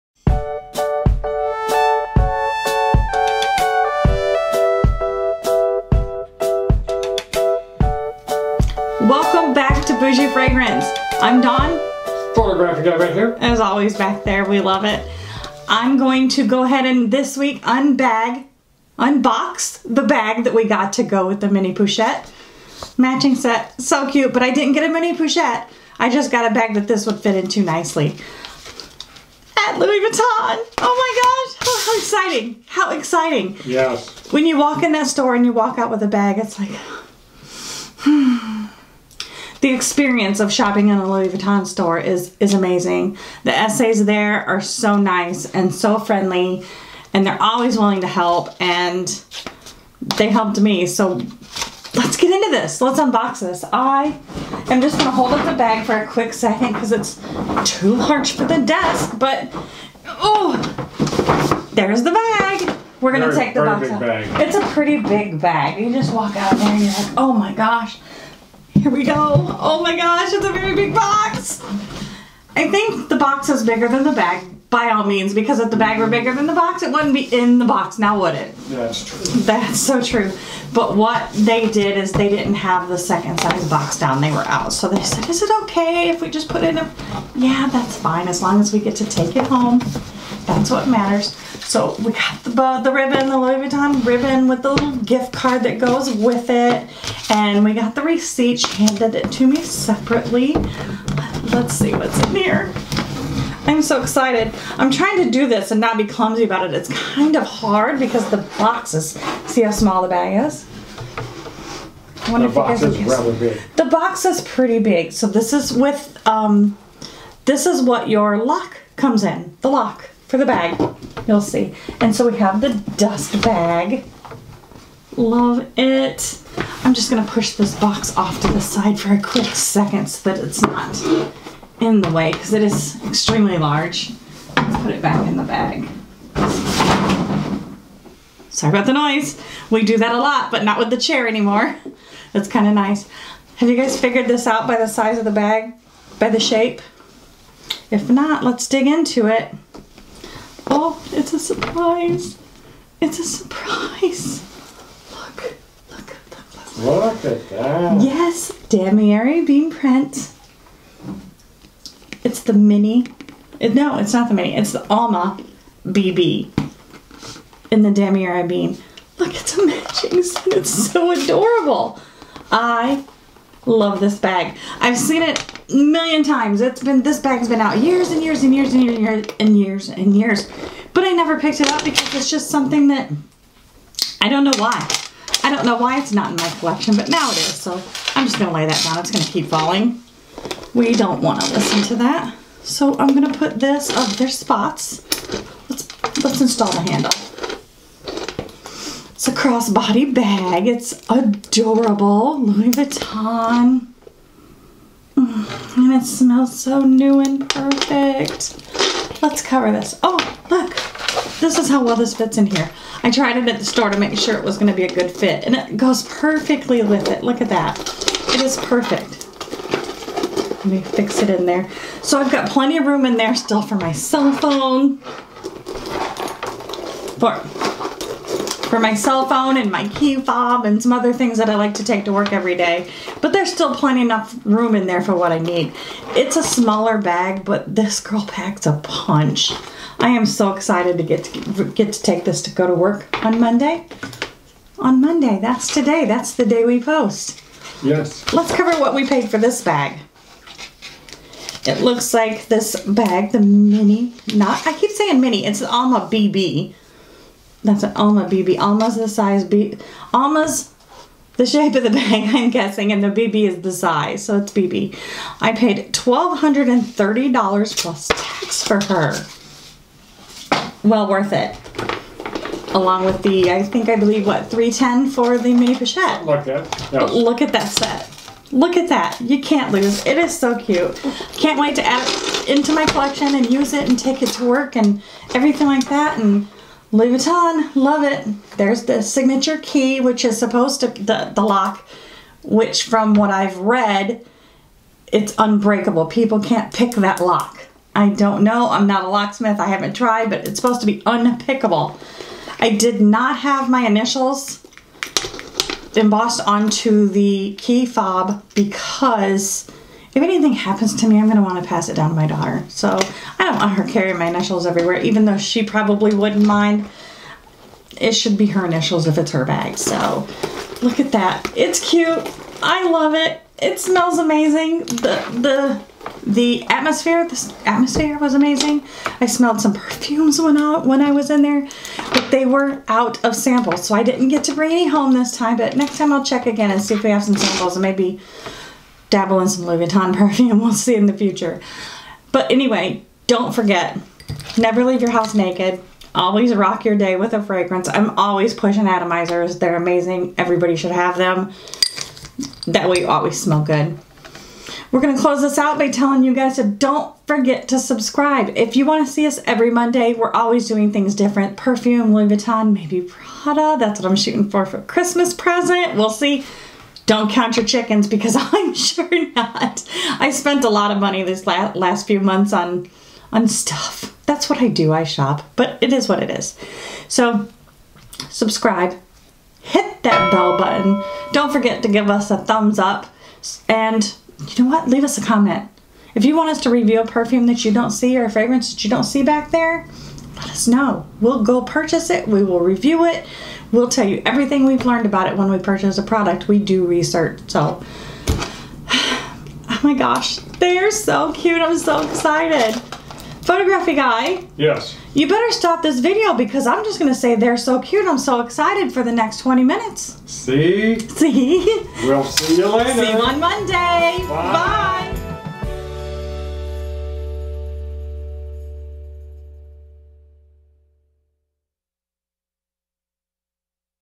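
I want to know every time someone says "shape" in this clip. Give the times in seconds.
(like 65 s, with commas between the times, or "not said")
146 s, 261 s.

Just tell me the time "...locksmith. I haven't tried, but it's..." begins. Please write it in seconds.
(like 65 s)
299 s.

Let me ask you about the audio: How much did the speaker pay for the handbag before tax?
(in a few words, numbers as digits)
$1,230.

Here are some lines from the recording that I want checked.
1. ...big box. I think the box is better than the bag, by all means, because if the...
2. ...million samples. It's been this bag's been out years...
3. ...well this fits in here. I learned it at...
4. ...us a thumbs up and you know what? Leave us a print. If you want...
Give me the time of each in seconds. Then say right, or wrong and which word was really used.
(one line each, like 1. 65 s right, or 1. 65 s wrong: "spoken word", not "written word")
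1. 70 s wrong: "bigger", not "better"
2. 175 s wrong: "times", not "samples"
3. 211 s wrong: "tried", not "learned"
4. 382 s wrong: "comment", not "print".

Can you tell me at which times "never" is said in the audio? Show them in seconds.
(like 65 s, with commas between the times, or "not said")
181 s, 344 s.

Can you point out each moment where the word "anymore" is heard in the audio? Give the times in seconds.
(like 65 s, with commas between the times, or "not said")
141 s.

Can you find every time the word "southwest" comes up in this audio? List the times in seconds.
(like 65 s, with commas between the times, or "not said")
not said.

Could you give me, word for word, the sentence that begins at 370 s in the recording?
I spent a lot of money this last, few months on on stuff.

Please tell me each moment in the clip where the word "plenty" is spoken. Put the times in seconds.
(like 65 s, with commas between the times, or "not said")
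222 s, 233 s.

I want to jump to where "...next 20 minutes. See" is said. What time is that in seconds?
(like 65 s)
409 s.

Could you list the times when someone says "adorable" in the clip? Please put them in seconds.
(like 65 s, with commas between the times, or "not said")
171 s, 201 s.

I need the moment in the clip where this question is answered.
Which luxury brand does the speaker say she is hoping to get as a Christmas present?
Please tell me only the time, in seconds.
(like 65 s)
363 s.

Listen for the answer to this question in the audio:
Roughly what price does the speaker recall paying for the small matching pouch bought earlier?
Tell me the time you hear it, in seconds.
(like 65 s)
274 s.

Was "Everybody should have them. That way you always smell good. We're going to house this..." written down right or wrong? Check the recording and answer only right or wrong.
wrong.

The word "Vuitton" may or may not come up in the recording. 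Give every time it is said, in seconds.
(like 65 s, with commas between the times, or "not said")
29 s, 41 s, 93 s, 202 s, 287 s, 339 s, 362 s.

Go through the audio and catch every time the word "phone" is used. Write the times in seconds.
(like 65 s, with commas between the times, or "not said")
224 s, 229 s.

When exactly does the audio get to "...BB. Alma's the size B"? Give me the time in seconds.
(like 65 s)
258 s.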